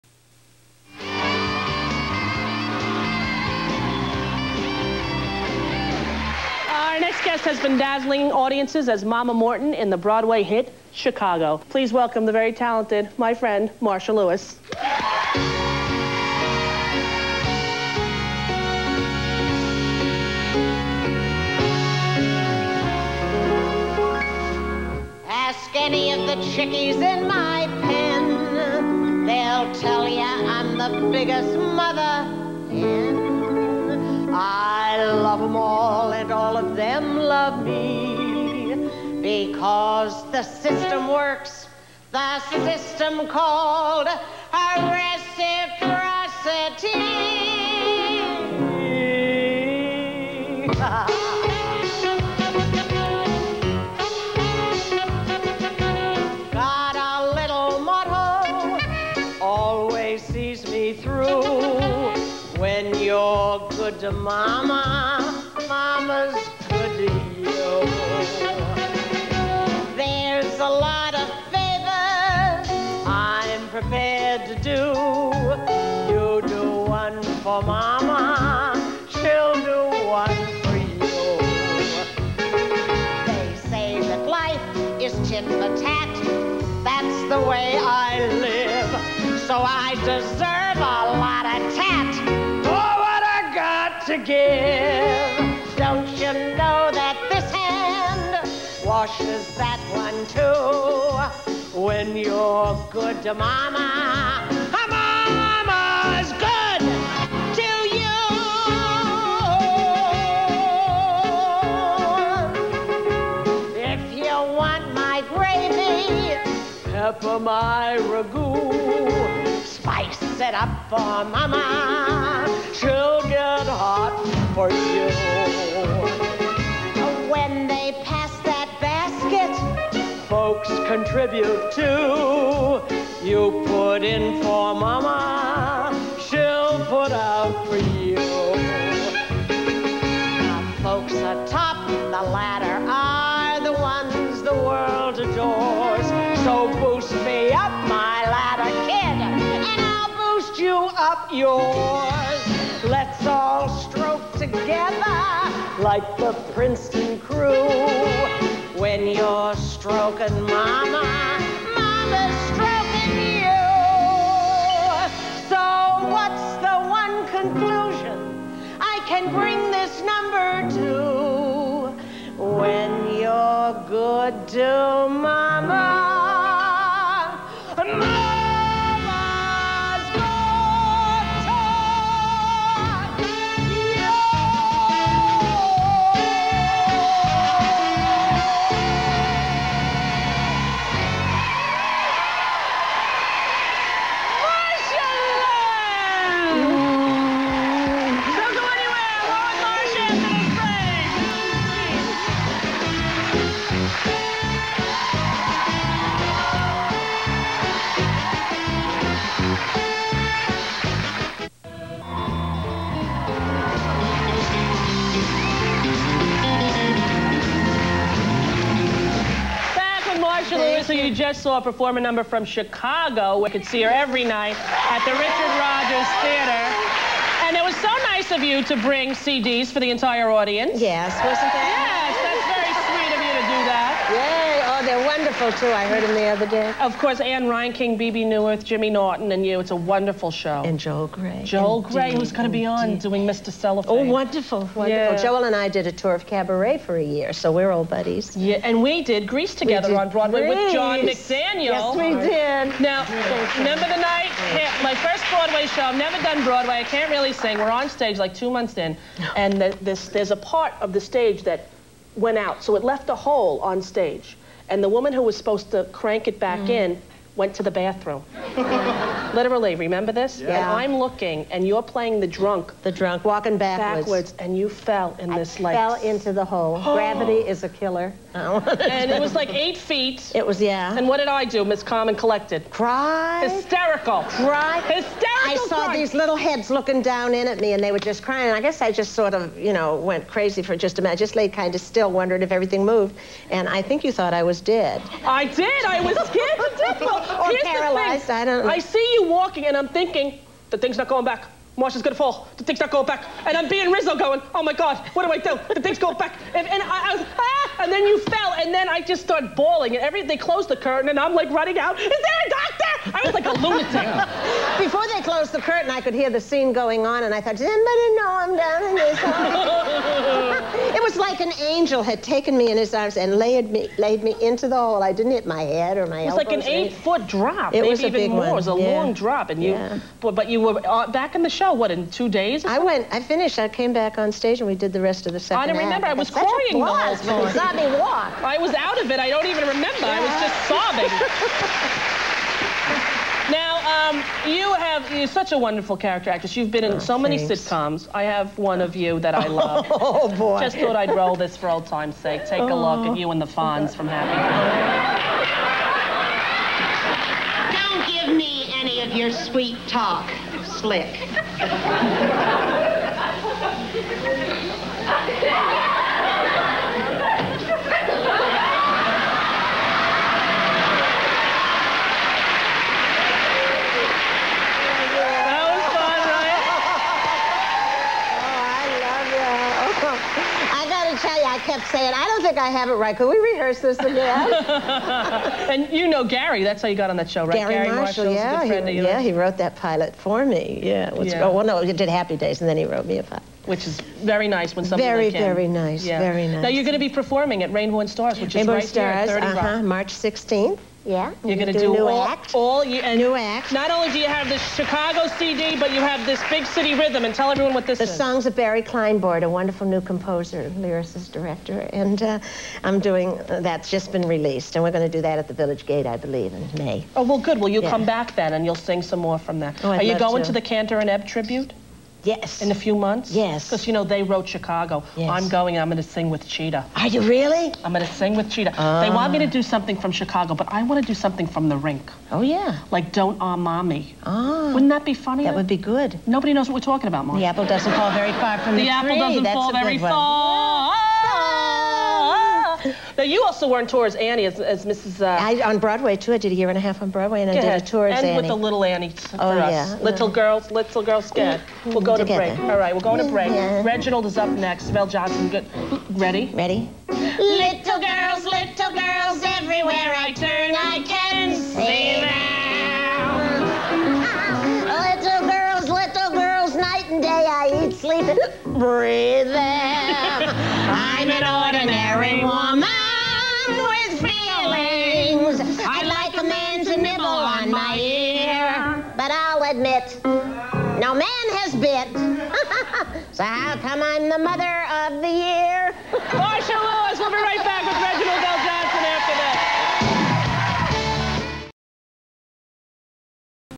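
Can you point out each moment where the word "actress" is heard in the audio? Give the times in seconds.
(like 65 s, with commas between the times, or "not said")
7 s, 346 s.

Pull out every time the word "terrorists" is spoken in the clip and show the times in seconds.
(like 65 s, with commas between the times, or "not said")
not said.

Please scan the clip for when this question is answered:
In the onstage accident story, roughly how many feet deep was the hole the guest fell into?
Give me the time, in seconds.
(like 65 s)
279 s.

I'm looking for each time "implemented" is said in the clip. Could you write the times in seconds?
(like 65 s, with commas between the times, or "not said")
not said.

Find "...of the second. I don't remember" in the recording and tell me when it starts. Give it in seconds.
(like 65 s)
335 s.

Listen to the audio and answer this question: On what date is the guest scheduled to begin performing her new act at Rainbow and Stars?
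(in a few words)
March 16th.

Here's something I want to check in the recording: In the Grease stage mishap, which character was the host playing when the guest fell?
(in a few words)
Rizzo.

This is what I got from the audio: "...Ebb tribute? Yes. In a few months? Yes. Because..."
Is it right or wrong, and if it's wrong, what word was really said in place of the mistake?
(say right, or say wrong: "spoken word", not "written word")
right.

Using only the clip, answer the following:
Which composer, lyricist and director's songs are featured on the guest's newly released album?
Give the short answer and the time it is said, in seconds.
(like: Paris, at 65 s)
Barry Kleinbort, at 408 s.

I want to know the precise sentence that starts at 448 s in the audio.
And with the little Annie oh, yeah.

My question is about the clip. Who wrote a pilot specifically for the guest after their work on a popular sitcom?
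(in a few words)
Garry Marshall.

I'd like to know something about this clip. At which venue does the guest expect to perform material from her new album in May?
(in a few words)
Village Gate.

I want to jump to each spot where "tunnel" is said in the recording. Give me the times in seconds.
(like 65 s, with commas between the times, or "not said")
not said.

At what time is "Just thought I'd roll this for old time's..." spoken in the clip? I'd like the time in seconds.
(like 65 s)
350 s.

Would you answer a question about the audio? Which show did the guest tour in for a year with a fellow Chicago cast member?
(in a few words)
Cabaret.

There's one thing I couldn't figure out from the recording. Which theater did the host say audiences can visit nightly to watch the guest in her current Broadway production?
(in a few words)
Richard Rodgers Theater.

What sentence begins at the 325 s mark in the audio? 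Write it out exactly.
I didn't hit my head or my elbows.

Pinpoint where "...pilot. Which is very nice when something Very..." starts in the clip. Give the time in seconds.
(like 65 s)
393 s.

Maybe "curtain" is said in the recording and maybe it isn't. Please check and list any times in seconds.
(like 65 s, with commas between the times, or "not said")
310 s, 315 s.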